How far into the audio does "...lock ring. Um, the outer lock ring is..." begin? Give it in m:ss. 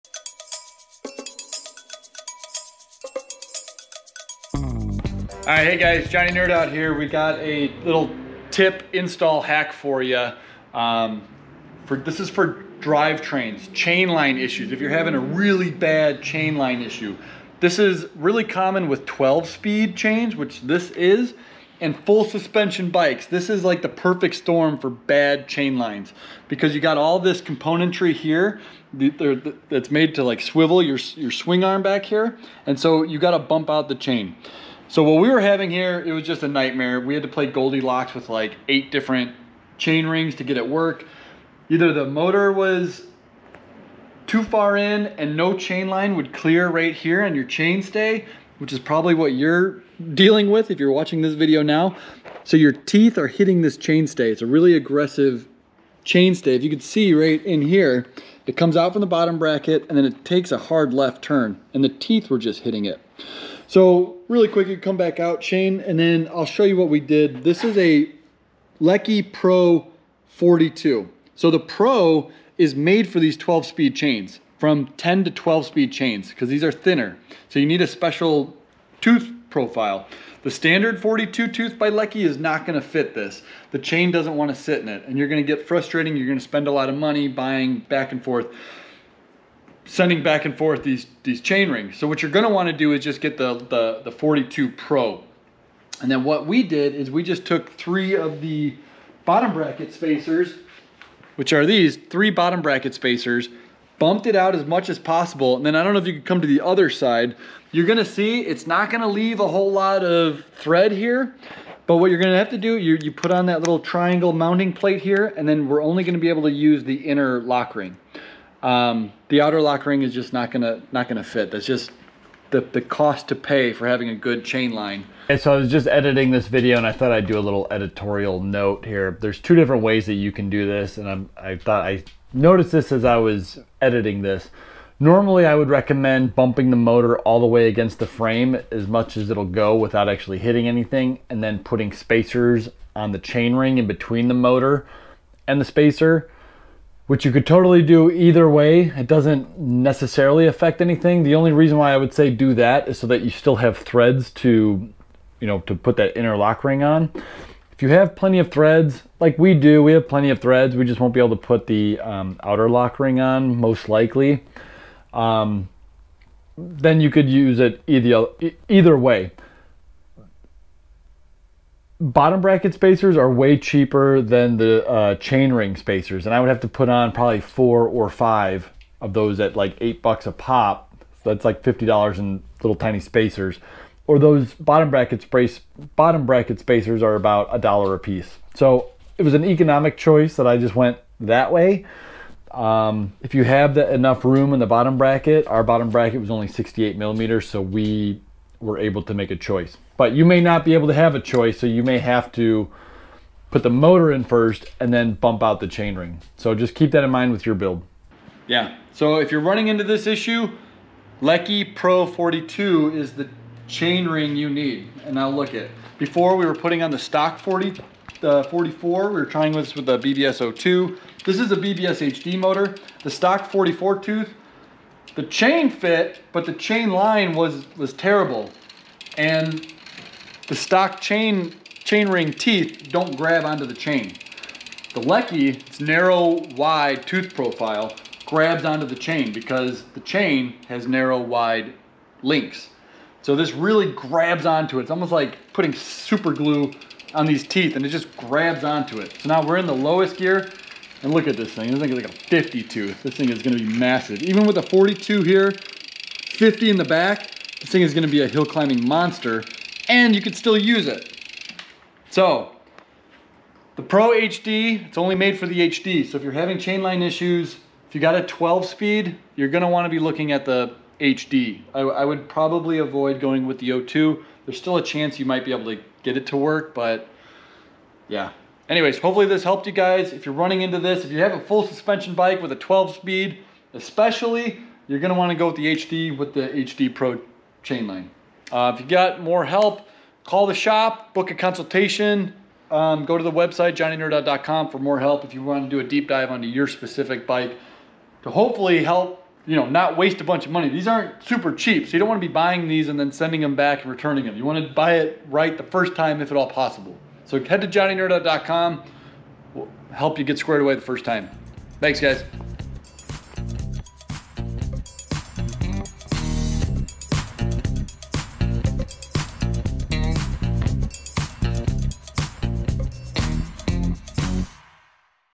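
1:57.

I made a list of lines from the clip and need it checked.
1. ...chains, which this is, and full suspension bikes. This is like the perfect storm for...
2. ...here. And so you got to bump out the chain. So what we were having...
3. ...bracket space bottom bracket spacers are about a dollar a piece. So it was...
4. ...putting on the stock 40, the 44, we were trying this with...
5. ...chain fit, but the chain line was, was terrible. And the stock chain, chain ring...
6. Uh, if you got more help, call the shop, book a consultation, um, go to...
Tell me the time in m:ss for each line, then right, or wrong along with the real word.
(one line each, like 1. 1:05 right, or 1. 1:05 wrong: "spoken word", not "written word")
1. 0:19 right
2. 0:32 right
3. 3:04 right
4. 3:36 right
5. 3:45 right
6. 4:48 right.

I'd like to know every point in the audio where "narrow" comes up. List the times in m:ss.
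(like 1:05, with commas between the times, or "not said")
3:55, 4:00.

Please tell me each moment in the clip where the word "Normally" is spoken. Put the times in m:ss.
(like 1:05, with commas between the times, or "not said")
2:14.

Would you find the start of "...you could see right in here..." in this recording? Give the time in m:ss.
0:56.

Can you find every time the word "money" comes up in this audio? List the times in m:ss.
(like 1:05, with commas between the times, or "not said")
1:26, 5:00.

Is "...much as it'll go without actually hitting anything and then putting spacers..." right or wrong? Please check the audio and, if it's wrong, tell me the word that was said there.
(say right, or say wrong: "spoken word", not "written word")
right.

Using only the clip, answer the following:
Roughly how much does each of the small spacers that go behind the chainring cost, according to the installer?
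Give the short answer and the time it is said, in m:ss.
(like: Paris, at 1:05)
$8, at 2:59.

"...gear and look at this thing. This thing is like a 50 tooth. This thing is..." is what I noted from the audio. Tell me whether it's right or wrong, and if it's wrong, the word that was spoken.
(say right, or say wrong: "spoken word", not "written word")
right.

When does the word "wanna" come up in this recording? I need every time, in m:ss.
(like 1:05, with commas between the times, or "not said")
1:24, 1:32, 4:45, 4:55.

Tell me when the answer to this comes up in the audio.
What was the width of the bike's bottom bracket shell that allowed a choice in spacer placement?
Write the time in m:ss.
3:16.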